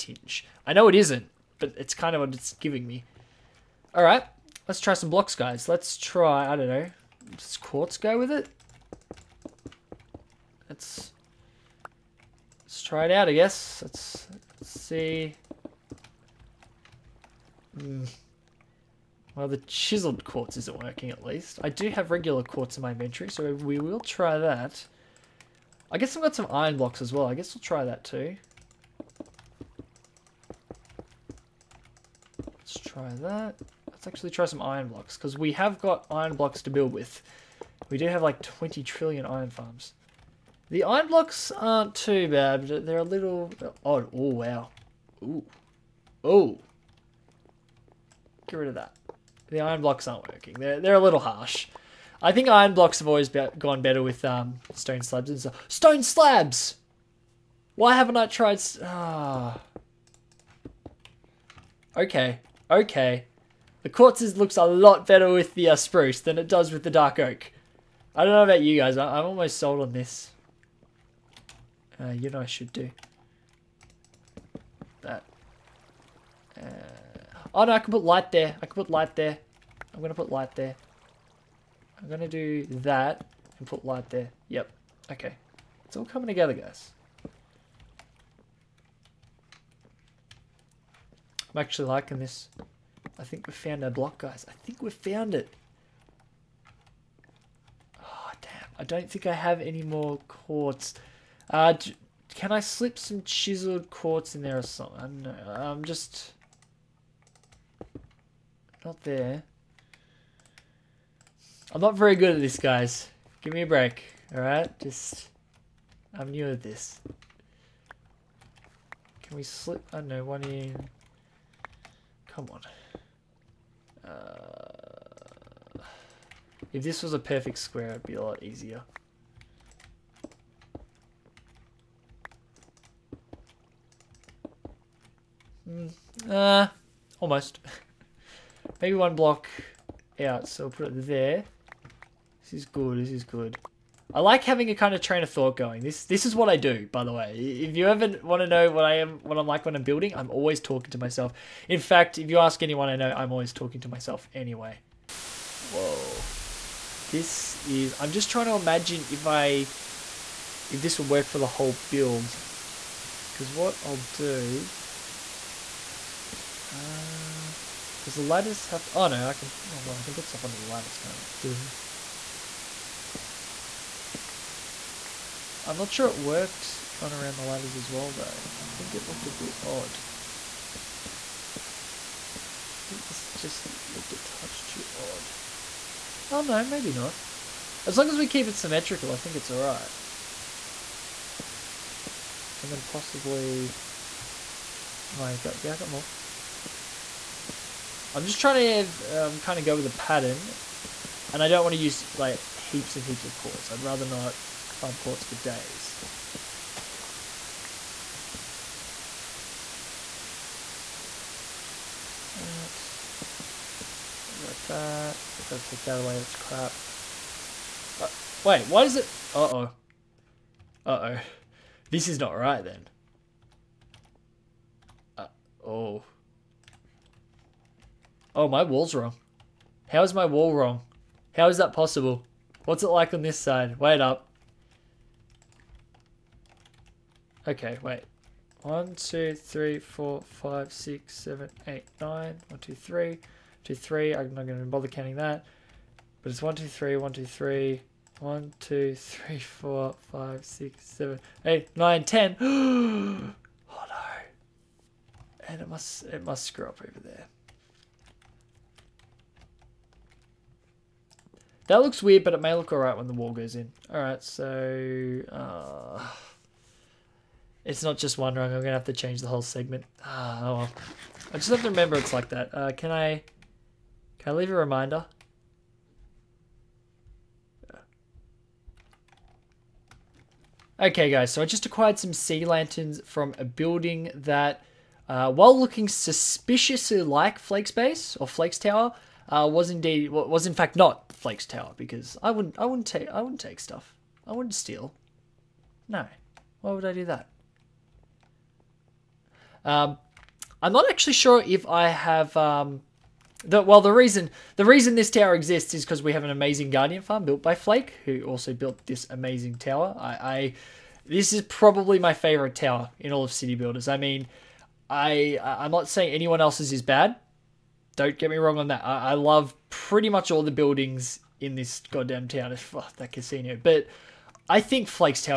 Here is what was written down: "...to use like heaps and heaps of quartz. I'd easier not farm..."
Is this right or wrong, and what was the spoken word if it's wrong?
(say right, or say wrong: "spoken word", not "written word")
wrong: "rather", not "easier".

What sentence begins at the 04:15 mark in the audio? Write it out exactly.
And it must, it must screw up over there.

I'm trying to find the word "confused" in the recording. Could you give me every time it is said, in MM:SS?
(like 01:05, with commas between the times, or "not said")
not said.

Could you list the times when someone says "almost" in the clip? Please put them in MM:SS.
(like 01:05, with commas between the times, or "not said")
01:09, 02:17.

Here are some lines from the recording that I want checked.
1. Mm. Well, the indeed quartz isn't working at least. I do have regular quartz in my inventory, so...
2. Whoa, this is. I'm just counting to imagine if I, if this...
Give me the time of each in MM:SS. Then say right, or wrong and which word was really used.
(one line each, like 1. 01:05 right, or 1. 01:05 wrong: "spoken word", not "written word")
1. 00:17 wrong: "chiseled", not "indeed"
2. 02:35 wrong: "trying", not "counting".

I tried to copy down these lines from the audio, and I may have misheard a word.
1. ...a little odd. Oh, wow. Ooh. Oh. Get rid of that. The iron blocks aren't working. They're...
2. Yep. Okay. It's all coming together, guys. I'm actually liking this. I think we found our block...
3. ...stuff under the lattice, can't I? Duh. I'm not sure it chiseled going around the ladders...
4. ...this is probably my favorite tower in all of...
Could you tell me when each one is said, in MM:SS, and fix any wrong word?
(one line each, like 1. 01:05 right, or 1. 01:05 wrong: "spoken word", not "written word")
1. 00:42 right
2. 01:24 right
3. 02:50 wrong: "worked", not "chiseled"
4. 05:11 right.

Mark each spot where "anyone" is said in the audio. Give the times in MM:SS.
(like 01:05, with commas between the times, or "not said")
02:32, 05:16.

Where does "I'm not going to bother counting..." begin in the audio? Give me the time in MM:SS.
04:04.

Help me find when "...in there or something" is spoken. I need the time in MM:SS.
01:44.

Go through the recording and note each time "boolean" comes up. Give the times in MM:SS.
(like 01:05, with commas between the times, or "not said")
not said.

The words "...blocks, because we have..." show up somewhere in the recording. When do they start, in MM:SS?
00:34.